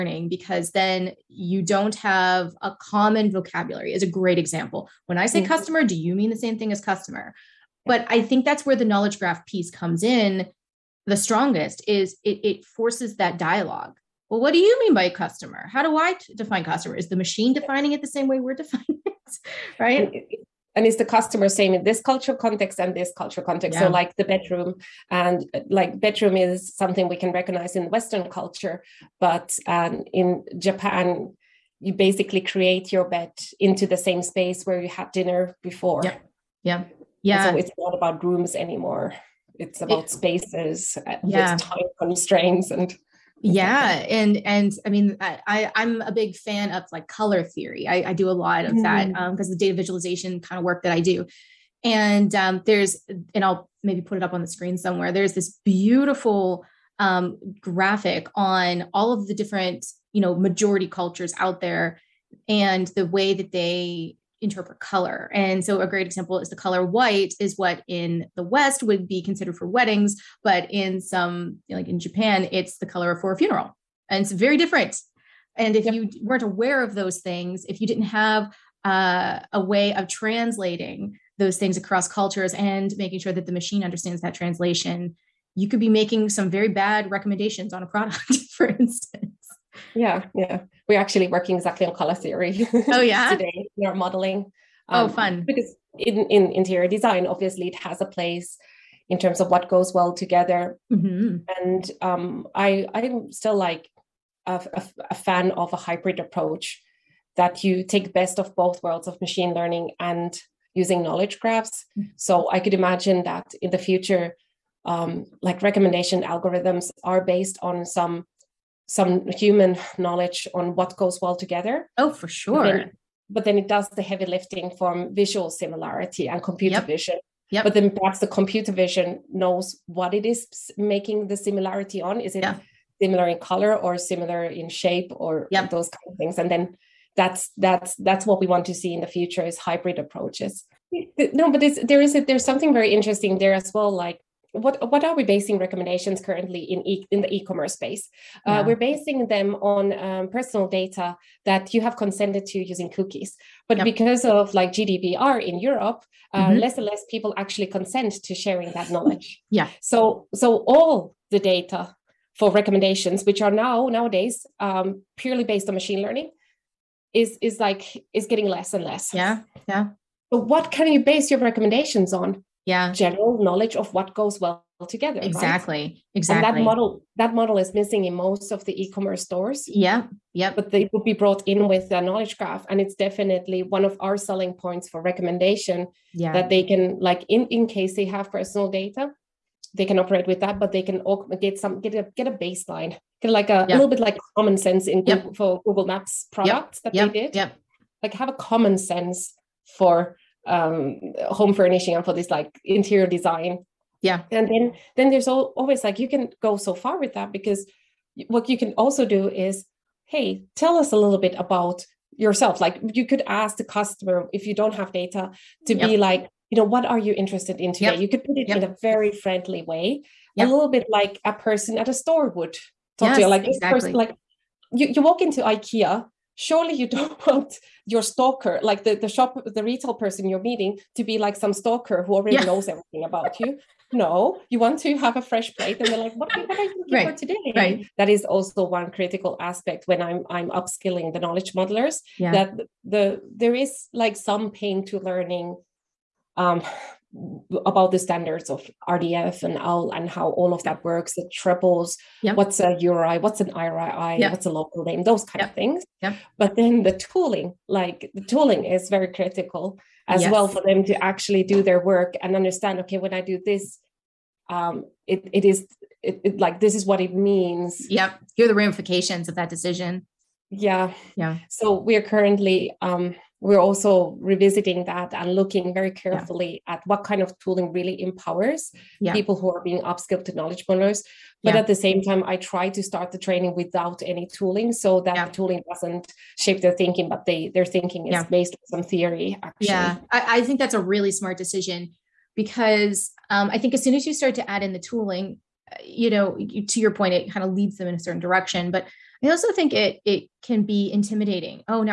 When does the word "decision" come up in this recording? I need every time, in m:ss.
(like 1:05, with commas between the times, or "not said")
4:29, 4:51.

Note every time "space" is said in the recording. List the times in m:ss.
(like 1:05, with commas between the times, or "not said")
0:34, 0:40, 2:27.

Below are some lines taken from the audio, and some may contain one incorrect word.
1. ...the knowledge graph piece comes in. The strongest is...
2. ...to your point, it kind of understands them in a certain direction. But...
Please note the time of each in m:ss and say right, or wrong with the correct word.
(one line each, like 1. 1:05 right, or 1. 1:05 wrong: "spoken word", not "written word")
1. 0:08 right
2. 4:56 wrong: "leads", not "understands".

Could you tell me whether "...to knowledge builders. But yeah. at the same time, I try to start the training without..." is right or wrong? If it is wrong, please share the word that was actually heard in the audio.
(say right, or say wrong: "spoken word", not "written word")
right.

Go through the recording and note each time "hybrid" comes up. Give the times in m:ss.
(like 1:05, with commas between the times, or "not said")
1:45, 2:19.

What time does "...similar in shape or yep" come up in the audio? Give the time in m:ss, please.
2:13.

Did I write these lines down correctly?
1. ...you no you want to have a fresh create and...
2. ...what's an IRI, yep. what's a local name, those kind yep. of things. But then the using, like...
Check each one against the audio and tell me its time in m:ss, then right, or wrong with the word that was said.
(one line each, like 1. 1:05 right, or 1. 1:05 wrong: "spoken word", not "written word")
1. 3:53 wrong: "plate", not "create"
2. 4:13 wrong: "tooling", not "using".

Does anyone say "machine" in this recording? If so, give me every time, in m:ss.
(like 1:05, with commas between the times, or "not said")
0:17, 1:23, 1:49, 2:45.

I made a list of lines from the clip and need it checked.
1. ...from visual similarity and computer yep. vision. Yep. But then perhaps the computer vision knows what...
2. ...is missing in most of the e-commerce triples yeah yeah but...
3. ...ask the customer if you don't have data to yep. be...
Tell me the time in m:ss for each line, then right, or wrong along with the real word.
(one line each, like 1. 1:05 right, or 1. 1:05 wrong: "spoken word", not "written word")
1. 2:04 right
2. 2:57 wrong: "stores", not "triples"
3. 3:33 right.